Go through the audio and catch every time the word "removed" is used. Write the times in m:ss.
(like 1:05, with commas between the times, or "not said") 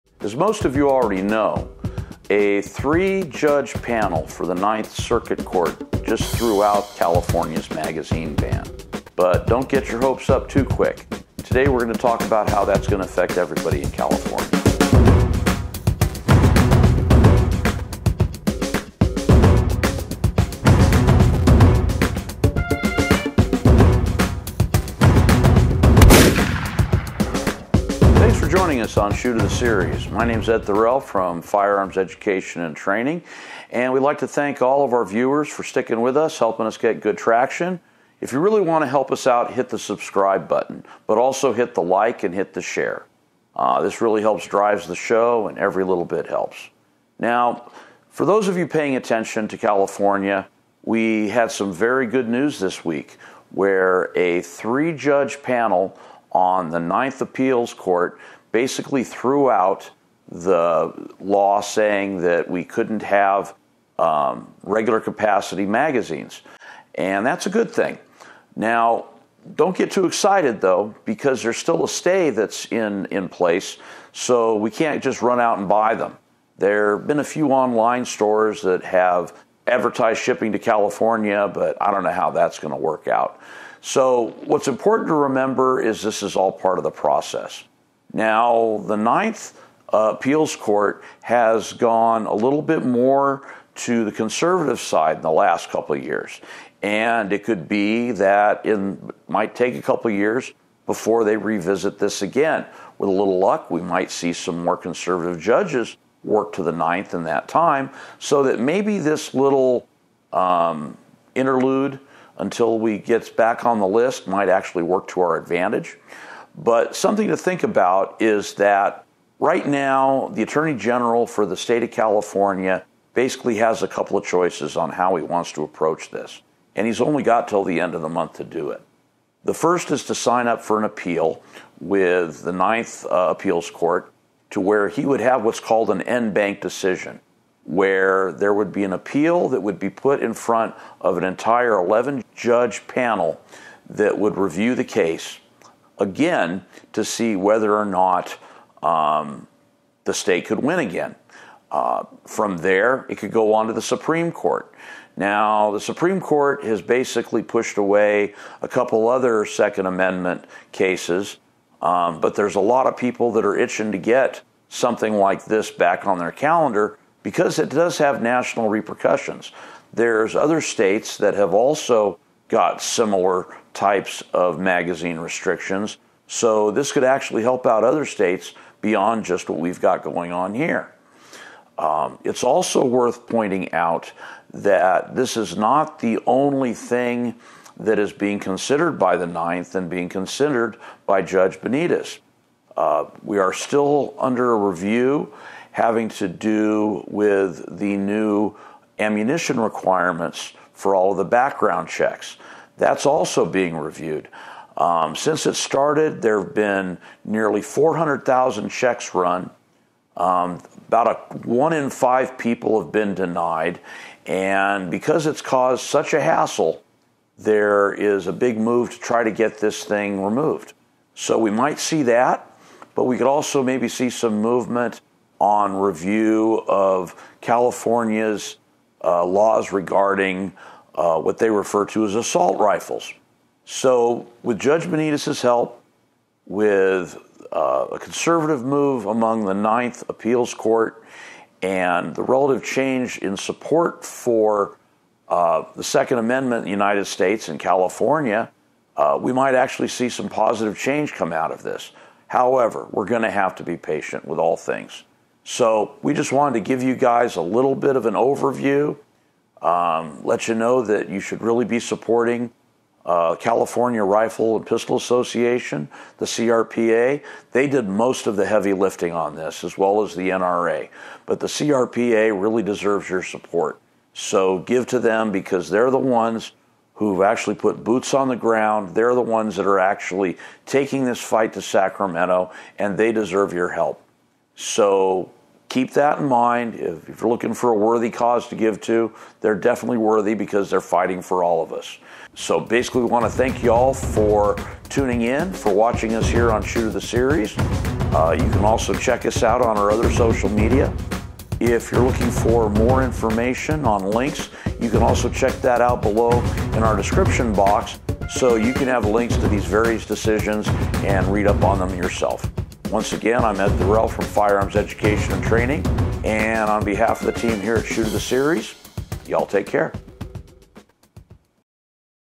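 3:40.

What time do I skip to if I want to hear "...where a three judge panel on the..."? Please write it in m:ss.
0:53.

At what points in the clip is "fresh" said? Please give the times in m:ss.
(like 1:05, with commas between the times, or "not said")
not said.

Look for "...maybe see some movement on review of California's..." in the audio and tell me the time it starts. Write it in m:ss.
3:43.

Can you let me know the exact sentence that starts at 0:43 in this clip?
Uh, this really helps drives the show, and every little bit helps.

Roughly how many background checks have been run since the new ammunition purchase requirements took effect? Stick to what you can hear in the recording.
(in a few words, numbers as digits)
400,000.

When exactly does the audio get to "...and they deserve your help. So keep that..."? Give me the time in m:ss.
4:42.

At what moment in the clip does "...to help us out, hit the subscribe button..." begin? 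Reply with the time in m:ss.
0:38.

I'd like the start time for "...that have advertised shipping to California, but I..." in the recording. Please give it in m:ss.
1:18.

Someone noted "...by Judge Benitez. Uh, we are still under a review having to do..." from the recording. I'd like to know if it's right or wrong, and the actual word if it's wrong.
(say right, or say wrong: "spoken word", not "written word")
right.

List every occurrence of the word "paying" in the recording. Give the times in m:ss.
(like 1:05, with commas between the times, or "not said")
0:48.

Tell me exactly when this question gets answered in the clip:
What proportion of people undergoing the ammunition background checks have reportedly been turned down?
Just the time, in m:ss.
3:31.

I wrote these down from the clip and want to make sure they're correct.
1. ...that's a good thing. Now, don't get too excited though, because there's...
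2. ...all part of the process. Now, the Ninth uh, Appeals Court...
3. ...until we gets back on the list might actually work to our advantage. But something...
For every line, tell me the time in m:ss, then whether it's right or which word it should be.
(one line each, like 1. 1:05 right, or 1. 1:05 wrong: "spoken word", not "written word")
1. 1:07 right
2. 1:26 right
3. 1:52 right.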